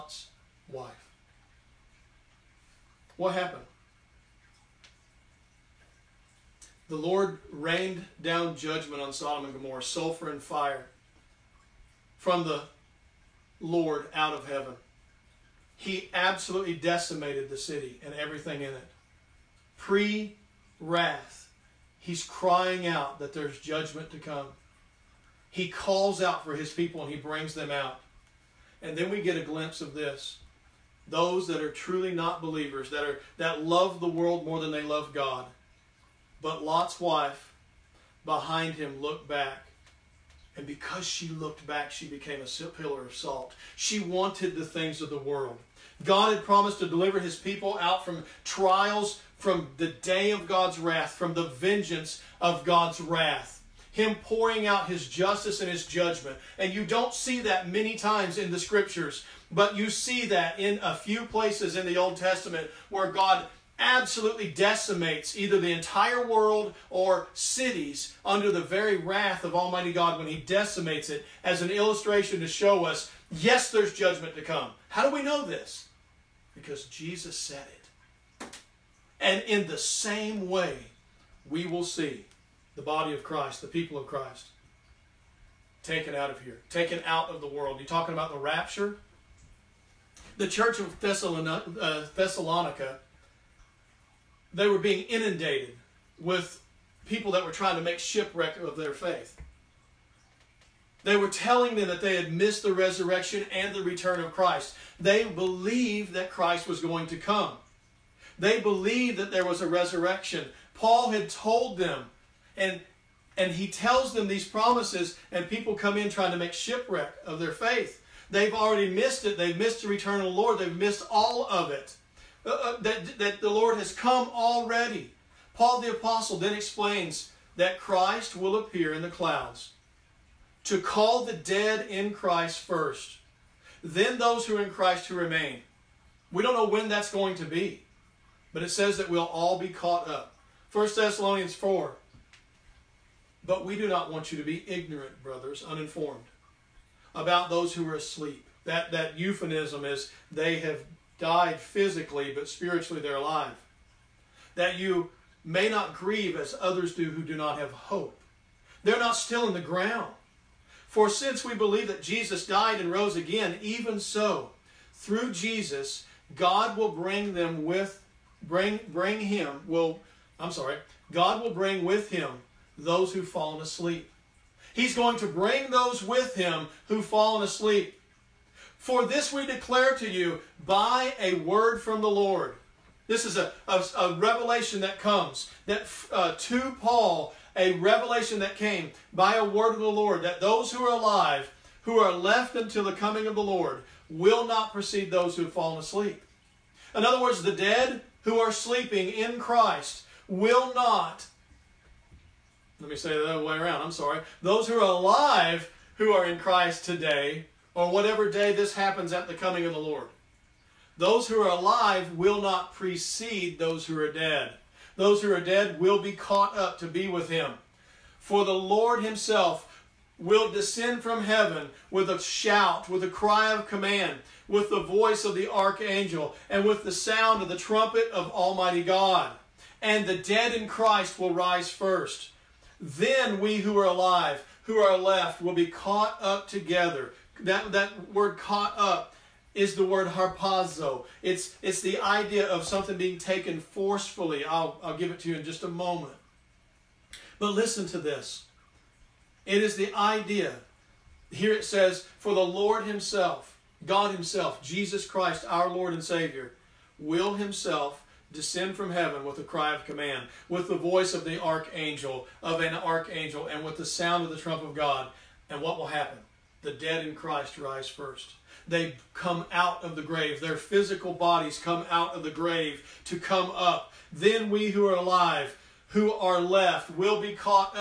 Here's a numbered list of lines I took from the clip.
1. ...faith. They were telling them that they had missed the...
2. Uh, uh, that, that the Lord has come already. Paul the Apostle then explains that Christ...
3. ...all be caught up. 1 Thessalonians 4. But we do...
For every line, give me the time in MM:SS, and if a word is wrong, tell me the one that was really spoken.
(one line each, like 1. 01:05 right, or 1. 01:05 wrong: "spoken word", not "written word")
1. 01:38 right
2. 02:02 right
3. 02:19 right.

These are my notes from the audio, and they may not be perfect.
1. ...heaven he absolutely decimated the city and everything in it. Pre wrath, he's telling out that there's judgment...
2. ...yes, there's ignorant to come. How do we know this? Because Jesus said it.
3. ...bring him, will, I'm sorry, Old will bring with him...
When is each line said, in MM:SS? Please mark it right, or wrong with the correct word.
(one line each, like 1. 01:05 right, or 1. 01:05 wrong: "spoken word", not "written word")
1. 00:14 wrong: "crying", not "telling"
2. 01:13 wrong: "judgment", not "ignorant"
3. 02:48 wrong: "God", not "Old".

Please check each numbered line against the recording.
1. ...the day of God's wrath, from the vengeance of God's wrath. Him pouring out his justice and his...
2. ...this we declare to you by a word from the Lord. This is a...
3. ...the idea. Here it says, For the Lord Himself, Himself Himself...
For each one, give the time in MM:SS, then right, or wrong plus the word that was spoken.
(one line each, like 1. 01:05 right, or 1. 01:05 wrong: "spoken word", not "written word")
1. 00:49 right
2. 02:59 right
3. 04:09 wrong: "God", not "Himself".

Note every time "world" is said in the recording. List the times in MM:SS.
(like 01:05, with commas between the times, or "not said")
00:34, 00:45, 01:06, 01:27.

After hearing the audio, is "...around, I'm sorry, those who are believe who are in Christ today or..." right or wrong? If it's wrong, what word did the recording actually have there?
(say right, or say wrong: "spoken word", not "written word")
wrong: "alive", not "believe".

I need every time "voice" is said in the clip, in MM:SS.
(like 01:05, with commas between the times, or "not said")
03:44, 04:20.